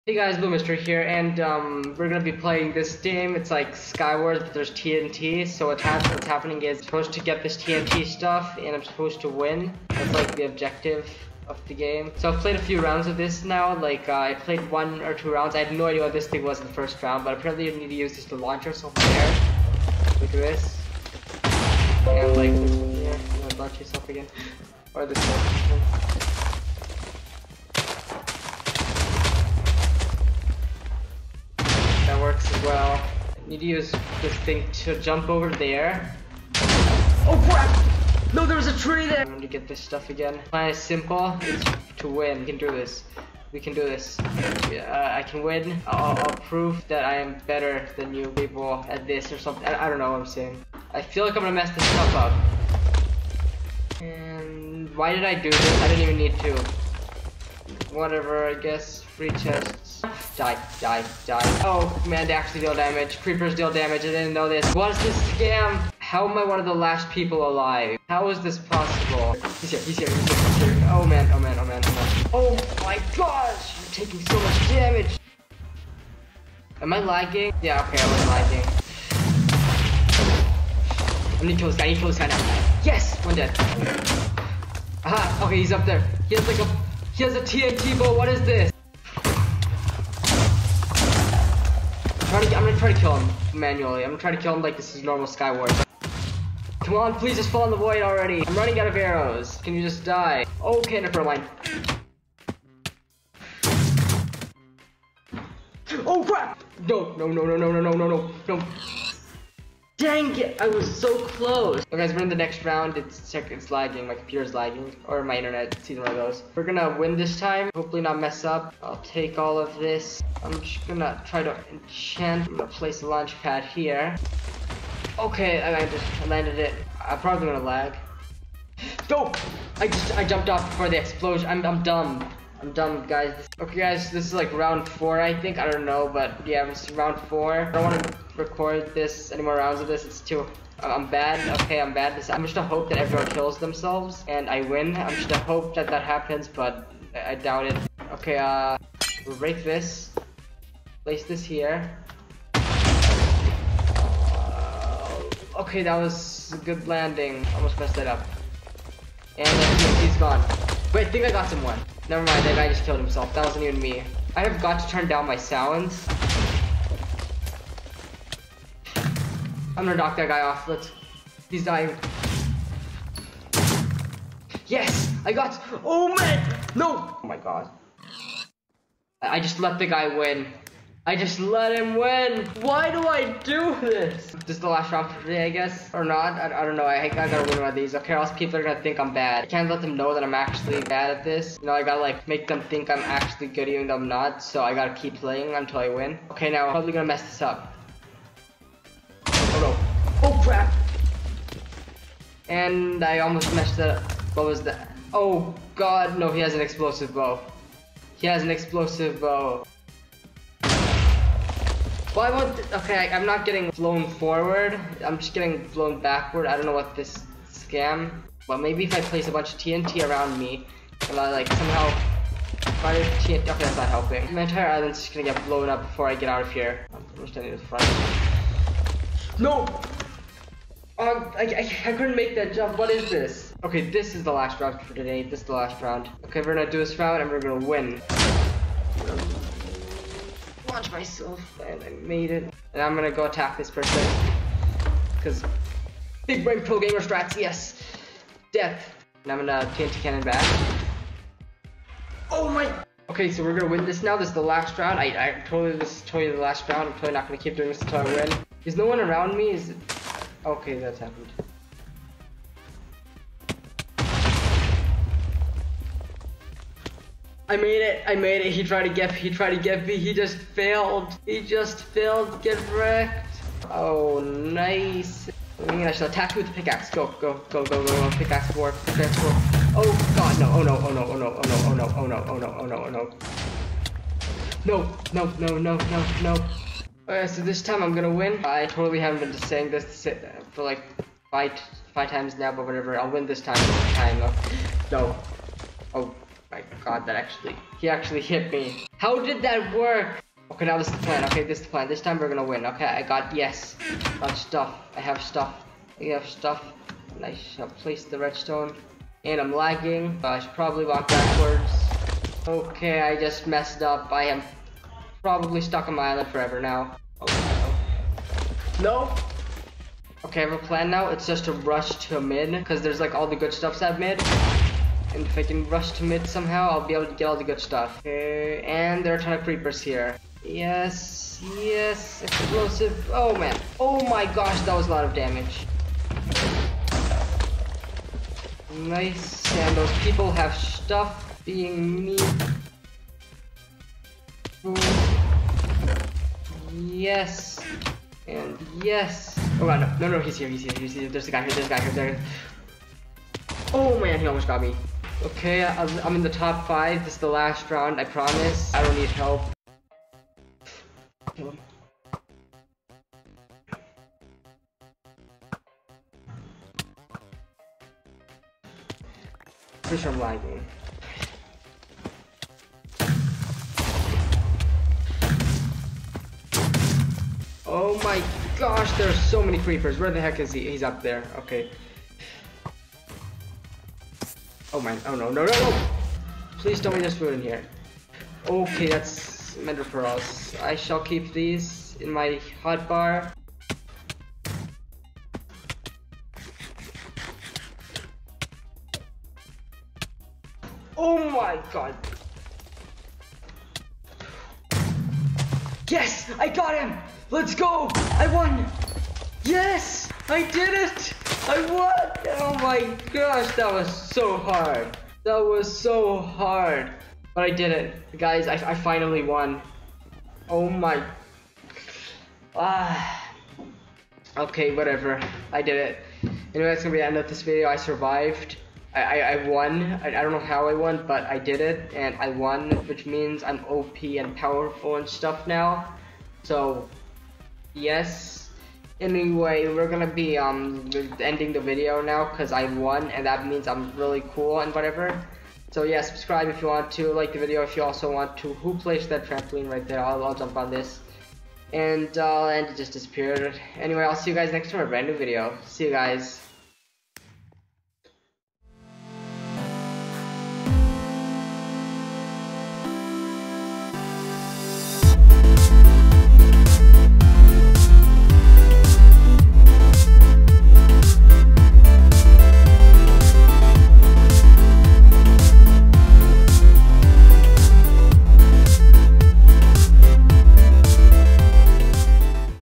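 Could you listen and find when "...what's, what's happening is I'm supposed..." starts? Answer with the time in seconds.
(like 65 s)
5 s.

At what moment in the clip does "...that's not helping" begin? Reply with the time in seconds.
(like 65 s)
223 s.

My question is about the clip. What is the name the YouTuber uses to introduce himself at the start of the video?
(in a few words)
BlueMystery.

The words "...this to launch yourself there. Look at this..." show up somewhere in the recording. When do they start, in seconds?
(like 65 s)
18 s.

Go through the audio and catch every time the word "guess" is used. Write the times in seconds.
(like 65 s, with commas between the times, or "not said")
58 s, 185 s.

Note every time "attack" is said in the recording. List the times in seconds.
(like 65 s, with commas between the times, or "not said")
243 s, 276 s.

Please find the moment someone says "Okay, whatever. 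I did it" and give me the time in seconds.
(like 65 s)
424 s.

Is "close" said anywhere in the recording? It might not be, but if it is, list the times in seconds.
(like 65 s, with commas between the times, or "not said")
111 s.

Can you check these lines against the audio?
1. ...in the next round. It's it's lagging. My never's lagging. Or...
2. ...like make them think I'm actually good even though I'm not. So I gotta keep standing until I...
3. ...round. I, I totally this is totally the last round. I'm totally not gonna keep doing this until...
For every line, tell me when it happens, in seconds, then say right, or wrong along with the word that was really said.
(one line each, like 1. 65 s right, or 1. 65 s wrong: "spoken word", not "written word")
1. 112 s wrong: "computer", not "never"
2. 192 s wrong: "playing", not "standing"
3. 254 s right.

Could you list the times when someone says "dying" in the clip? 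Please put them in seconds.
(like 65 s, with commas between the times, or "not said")
171 s.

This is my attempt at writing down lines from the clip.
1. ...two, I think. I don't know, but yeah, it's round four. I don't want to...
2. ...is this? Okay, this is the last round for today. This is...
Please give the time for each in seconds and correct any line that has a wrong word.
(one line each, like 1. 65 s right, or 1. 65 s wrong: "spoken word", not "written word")
1. 134 s wrong: "four", not "two"
2. 232 s right.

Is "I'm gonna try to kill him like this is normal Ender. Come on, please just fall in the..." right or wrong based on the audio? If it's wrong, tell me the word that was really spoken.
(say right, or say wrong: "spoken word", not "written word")
wrong: "Skywars", not "Ender".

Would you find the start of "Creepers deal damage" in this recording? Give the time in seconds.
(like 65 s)
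63 s.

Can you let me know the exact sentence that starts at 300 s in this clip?
Okay, now this is the plan.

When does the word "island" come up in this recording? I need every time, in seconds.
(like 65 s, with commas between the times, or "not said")
224 s, 316 s.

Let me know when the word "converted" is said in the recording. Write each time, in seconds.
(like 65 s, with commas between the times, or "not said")
not said.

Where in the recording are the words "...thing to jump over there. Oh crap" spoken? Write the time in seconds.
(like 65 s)
34 s.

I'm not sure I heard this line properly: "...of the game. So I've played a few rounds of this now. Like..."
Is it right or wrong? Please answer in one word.
right.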